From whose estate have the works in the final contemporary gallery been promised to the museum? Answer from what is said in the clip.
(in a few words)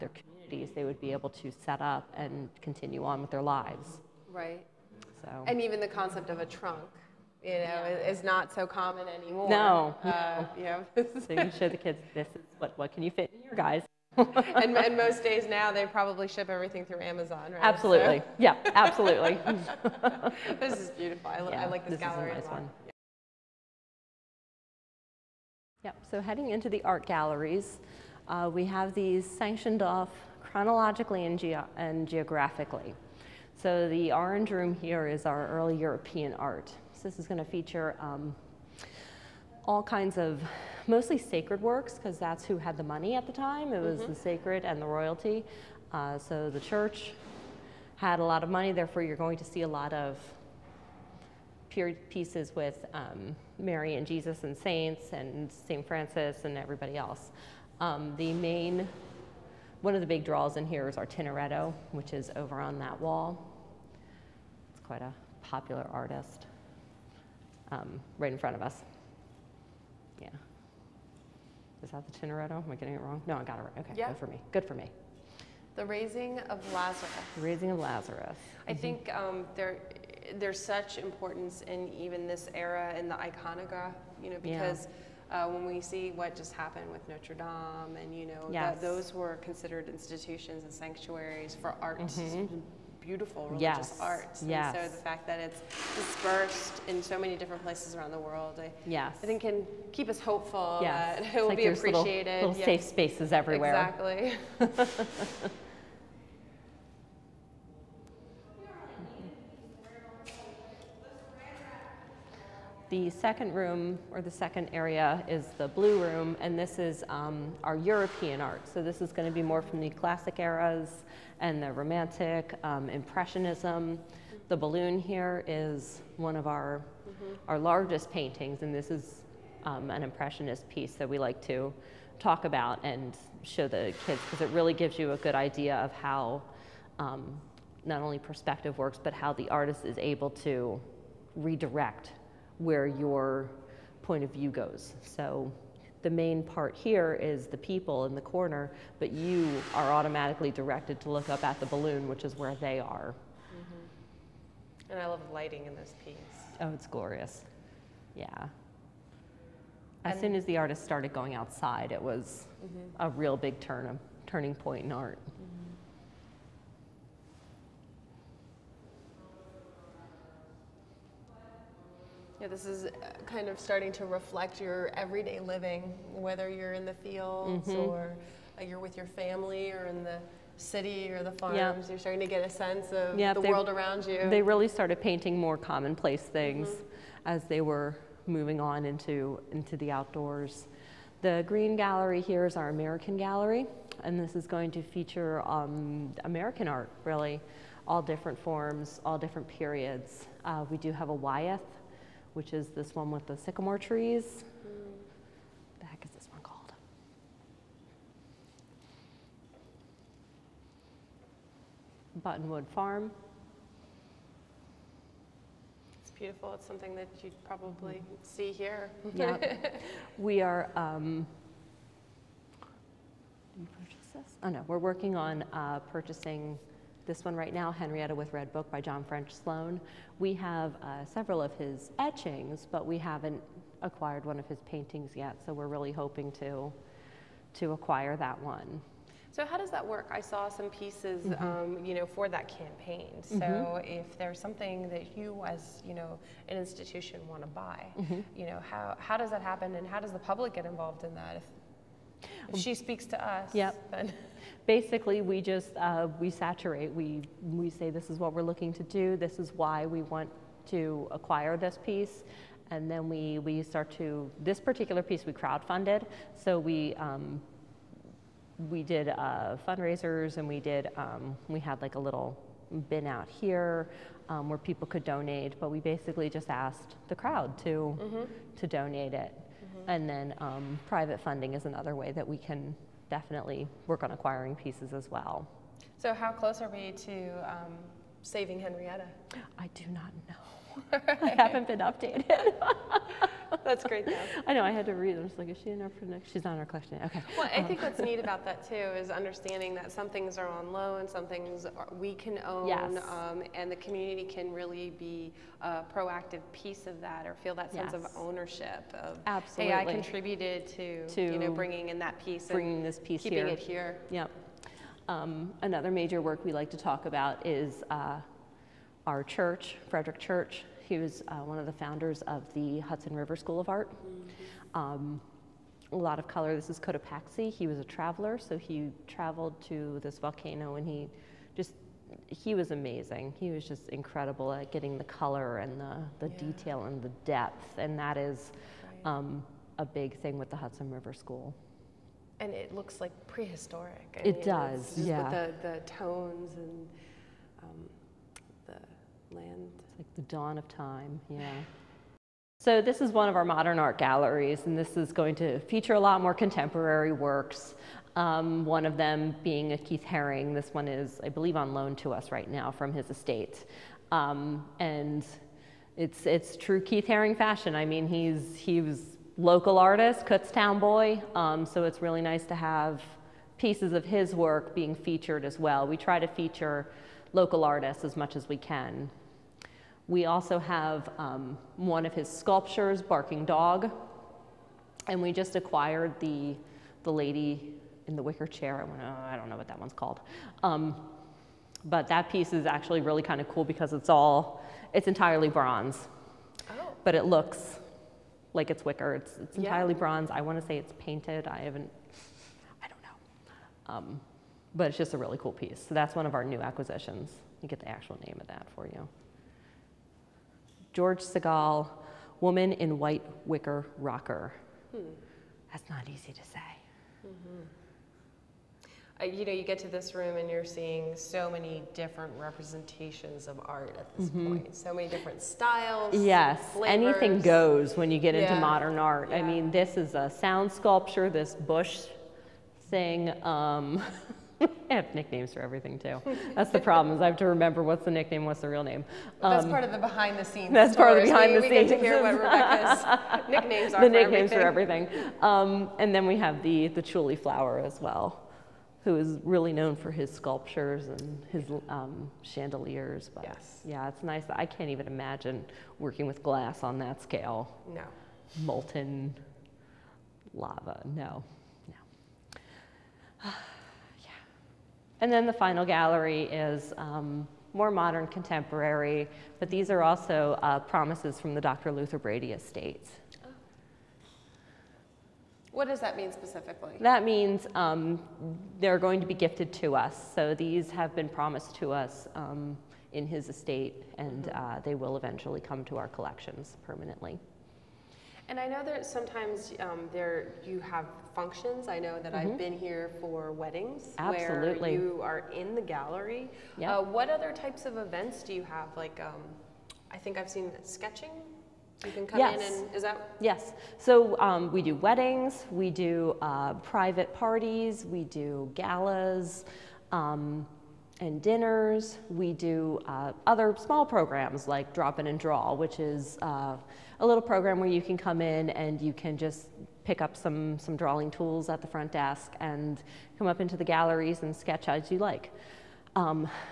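Dr. Luther Brady.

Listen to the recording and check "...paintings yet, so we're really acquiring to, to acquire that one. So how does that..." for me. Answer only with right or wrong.
wrong.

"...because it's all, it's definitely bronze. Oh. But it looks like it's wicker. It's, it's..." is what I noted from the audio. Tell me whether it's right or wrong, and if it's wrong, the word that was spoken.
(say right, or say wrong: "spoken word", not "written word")
wrong: "entirely", not "definitely".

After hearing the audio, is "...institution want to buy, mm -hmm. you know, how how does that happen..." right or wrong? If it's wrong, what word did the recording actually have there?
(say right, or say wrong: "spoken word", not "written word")
right.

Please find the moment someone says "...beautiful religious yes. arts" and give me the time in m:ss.
1:33.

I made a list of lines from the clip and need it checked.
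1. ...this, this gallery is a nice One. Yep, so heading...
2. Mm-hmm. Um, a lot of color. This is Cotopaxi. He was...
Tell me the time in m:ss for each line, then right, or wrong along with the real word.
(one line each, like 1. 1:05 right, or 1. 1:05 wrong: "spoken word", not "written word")
1. 0:21 right
2. 5:23 right.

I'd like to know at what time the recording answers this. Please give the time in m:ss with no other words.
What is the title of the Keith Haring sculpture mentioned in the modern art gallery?
6:23.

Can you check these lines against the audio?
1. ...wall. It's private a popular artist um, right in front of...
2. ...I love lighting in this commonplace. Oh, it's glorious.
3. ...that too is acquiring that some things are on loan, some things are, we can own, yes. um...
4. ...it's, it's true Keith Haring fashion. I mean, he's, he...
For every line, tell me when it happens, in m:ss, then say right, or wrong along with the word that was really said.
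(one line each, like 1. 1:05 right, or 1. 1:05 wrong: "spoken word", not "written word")
1. 1:03 wrong: "quite", not "private"
2. 2:35 wrong: "piece", not "commonplace"
3. 4:58 wrong: "understanding", not "acquiring"
4. 6:05 right.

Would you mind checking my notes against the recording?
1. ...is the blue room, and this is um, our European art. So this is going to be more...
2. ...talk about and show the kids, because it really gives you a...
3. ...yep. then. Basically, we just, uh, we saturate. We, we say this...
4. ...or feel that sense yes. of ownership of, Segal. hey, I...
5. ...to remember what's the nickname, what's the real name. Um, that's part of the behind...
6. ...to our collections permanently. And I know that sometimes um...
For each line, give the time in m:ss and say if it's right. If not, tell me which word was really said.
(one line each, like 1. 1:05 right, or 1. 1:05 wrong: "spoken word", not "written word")
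1. 1:55 right
2. 2:12 right
3. 4:13 right
4. 5:07 wrong: "Absolutely", not "Segal"
5. 7:17 right
6. 8:05 right.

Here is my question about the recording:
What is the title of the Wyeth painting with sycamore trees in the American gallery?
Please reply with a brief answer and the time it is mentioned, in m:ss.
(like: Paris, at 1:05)
Buttonwood Farm, at 3:32.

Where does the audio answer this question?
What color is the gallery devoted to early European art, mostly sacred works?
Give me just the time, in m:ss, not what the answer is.
0:34.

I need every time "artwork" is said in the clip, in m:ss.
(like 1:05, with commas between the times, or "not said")
not said.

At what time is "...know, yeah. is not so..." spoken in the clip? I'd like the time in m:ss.
0:07.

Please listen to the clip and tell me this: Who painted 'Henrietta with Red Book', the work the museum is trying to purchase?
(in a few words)
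John French Sloan.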